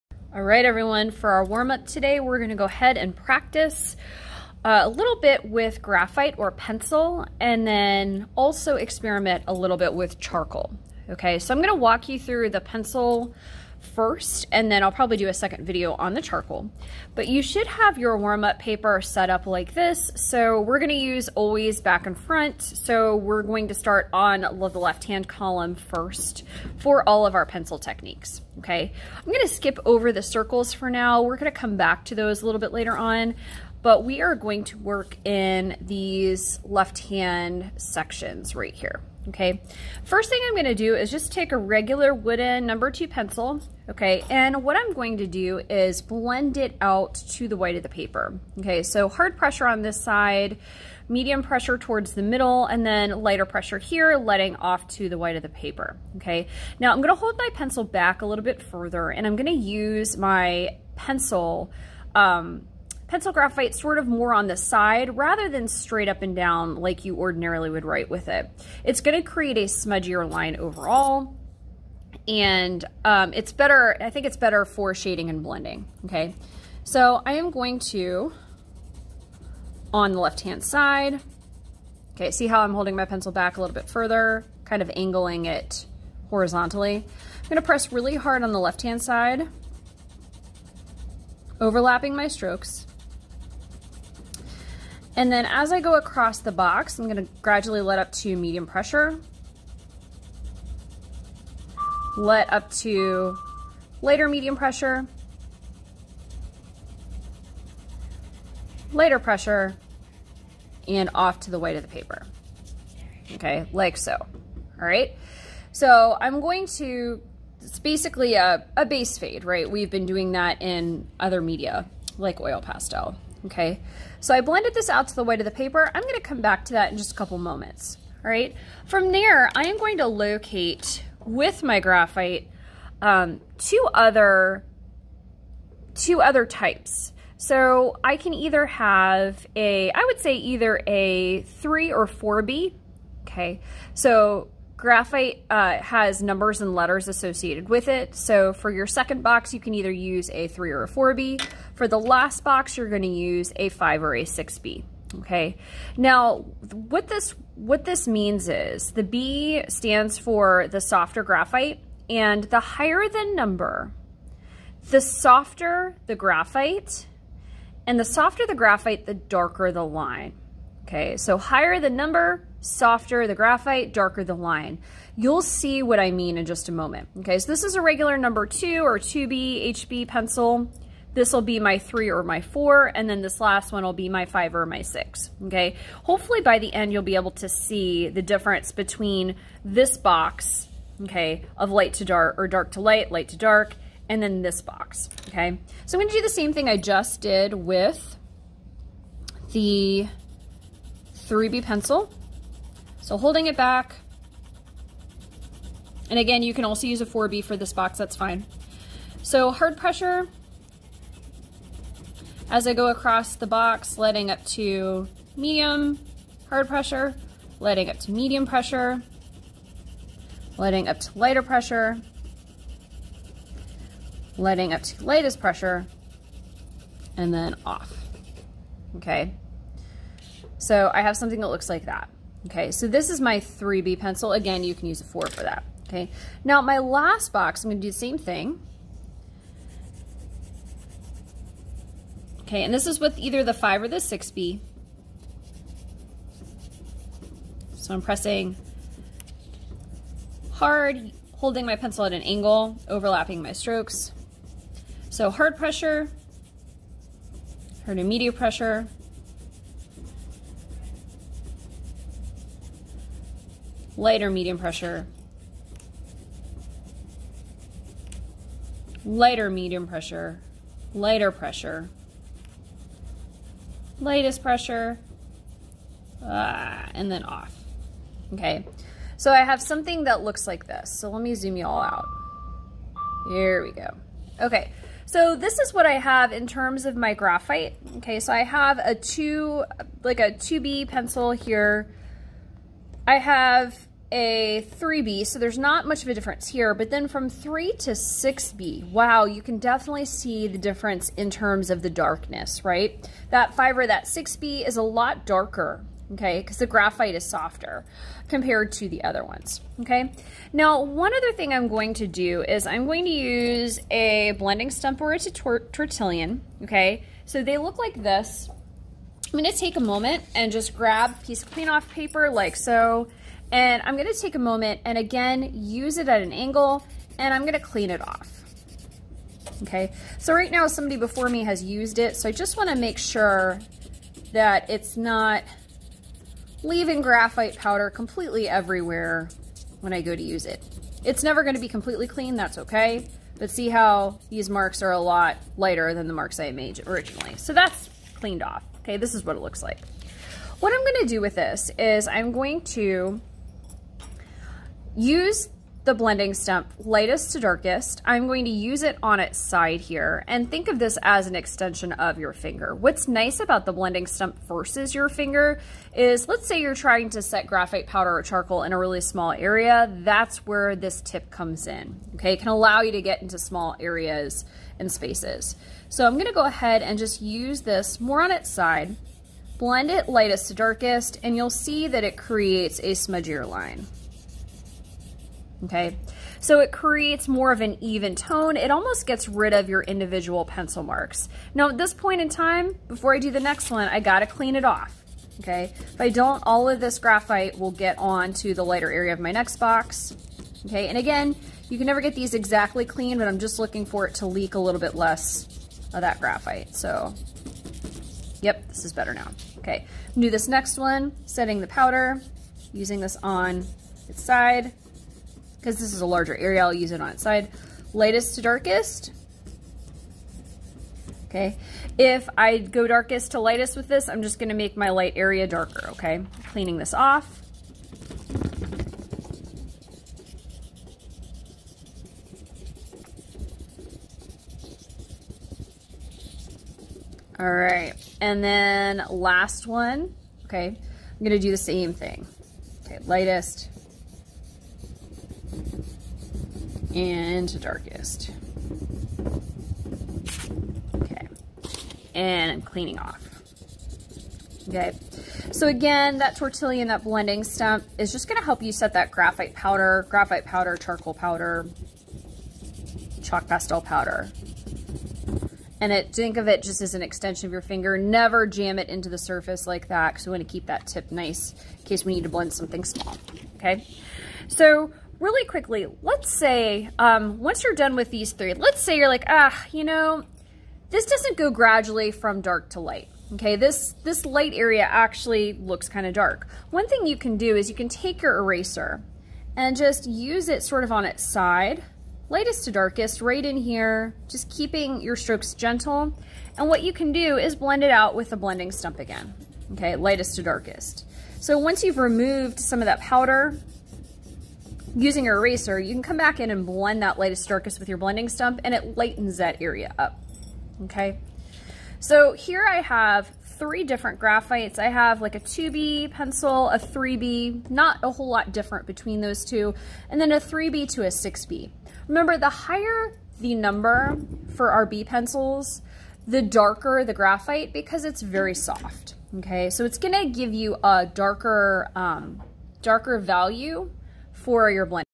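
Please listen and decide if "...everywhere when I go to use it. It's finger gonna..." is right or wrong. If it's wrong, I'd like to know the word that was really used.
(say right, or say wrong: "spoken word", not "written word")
wrong: "never", not "finger".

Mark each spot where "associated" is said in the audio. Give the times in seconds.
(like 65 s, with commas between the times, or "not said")
147 s.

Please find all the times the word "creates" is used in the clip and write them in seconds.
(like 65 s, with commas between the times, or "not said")
69 s, 382 s, 386 s.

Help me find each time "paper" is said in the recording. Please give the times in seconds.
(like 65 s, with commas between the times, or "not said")
18 s, 47 s, 55 s, 111 s, 125 s, 321 s.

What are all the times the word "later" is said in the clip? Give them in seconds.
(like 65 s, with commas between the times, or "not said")
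32 s.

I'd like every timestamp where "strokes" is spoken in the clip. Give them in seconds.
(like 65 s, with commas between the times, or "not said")
92 s, 253 s, 495 s.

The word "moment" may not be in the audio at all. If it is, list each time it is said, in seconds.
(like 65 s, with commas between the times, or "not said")
127 s, 176 s, 319 s, 324 s.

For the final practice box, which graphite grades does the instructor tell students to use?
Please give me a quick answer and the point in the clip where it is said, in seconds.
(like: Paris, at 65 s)
5 or 6B, at 152 s.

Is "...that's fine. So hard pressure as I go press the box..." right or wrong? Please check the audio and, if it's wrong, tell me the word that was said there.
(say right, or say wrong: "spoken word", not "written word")
wrong: "across", not "press".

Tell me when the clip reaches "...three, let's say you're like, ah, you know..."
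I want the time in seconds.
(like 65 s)
478 s.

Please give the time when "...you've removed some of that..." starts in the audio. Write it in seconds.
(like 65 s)
501 s.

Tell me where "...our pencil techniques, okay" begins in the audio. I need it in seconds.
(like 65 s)
27 s.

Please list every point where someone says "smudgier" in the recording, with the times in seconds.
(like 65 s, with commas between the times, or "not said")
69 s, 382 s.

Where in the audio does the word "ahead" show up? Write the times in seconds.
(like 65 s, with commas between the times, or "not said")
2 s, 376 s.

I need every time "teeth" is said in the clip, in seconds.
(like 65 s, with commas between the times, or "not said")
not said.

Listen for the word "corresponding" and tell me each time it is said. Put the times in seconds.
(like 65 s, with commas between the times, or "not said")
not said.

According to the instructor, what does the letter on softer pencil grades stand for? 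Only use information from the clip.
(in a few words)
softer graphite.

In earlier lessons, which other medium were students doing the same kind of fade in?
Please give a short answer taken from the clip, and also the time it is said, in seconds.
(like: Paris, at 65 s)
oil pastel, at 122 s.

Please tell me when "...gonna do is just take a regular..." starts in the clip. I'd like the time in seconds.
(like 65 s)
40 s.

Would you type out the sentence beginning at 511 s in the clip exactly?
So here I have three different graphites.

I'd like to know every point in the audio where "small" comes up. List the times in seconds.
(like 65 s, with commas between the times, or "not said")
369 s, 373 s, 472 s.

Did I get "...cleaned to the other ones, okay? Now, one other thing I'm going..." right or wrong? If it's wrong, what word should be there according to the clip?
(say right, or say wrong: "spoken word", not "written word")
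wrong: "compared", not "cleaned".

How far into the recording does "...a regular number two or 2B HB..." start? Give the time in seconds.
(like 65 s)
177 s.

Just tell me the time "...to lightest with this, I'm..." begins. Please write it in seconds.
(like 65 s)
423 s.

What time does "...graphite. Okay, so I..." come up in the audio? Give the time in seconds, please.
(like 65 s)
287 s.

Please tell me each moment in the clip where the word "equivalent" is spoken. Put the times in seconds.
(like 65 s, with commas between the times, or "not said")
not said.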